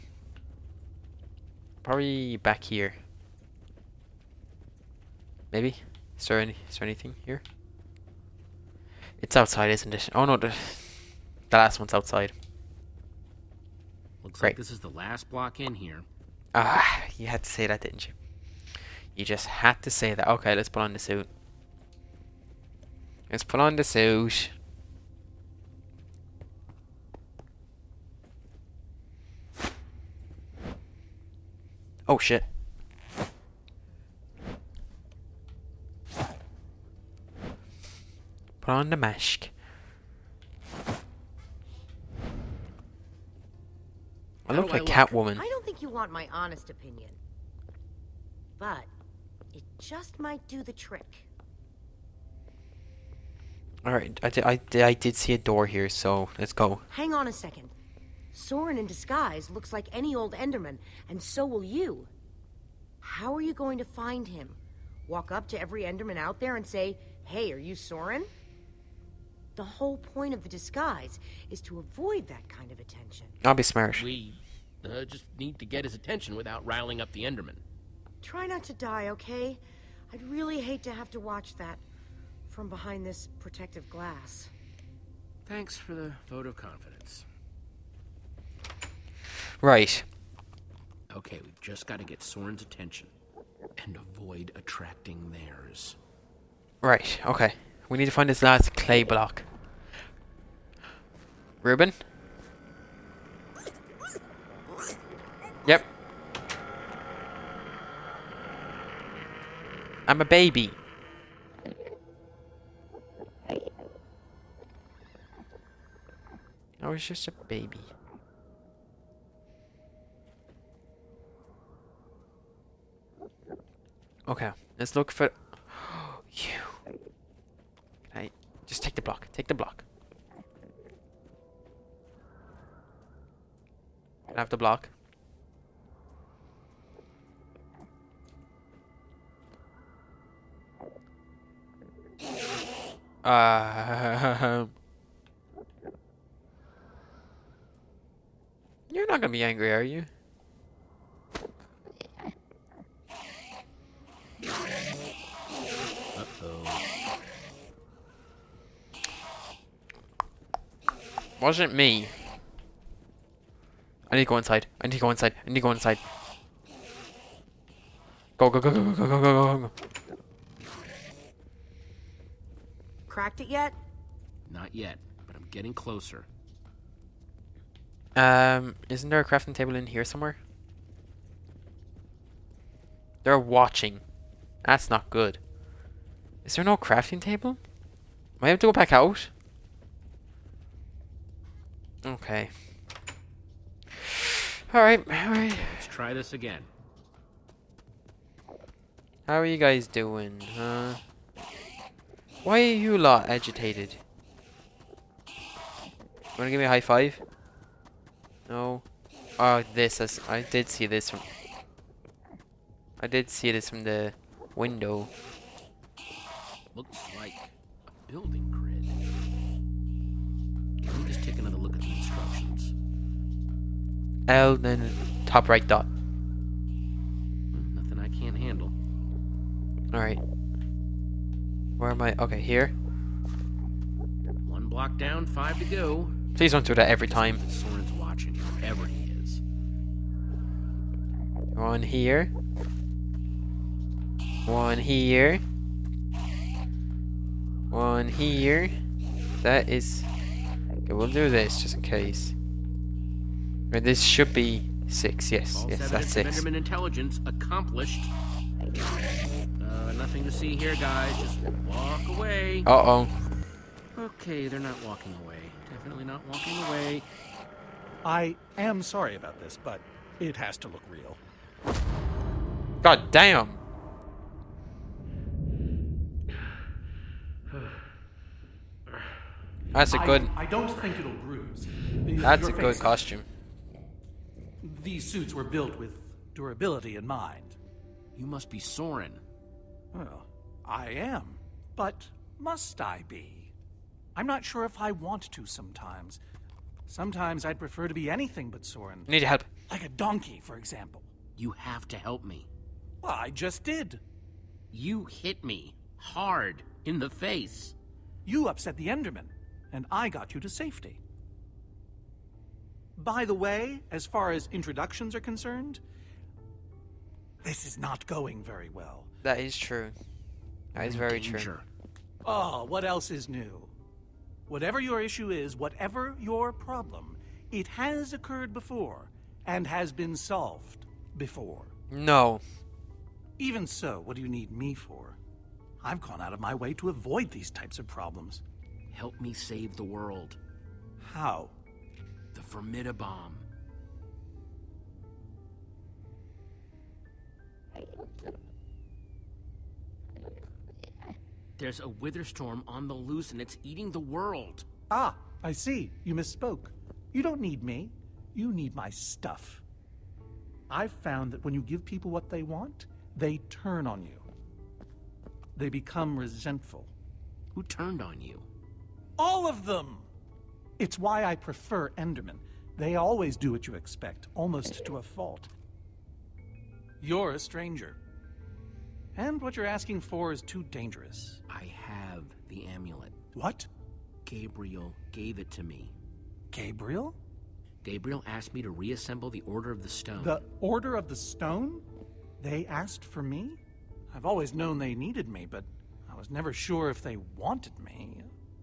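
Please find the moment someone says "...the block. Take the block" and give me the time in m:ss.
2:08.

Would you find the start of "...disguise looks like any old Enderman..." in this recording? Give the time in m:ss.
0:58.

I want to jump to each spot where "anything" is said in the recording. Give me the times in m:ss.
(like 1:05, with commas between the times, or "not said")
0:06, 4:58.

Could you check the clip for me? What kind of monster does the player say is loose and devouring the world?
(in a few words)
A Wither Storm.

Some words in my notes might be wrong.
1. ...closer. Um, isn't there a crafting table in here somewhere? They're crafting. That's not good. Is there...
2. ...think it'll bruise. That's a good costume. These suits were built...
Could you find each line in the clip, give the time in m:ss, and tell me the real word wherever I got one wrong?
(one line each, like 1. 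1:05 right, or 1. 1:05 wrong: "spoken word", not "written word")
1. 2:55 wrong: "watching", not "crafting"
2. 4:40 right.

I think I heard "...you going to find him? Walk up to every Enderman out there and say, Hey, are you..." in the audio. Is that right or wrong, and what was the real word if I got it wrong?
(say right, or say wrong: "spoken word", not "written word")
right.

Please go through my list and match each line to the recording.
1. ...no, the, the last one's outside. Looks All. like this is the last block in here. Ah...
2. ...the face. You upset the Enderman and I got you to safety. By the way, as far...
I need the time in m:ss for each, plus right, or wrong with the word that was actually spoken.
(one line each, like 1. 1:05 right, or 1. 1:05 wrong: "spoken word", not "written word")
1. 0:10 wrong: "Great", not "All"
2. 5:06 right.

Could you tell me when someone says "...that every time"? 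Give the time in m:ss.
3:56.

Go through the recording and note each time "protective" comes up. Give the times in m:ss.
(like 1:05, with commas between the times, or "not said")
1:23.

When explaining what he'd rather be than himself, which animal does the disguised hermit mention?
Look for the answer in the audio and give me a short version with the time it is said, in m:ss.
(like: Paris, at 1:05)
A donkey, at 4:59.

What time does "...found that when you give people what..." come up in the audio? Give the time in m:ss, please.
6:00.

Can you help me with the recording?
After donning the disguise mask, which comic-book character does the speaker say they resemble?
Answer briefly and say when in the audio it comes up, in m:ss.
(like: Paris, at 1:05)
Catwoman, at 0:44.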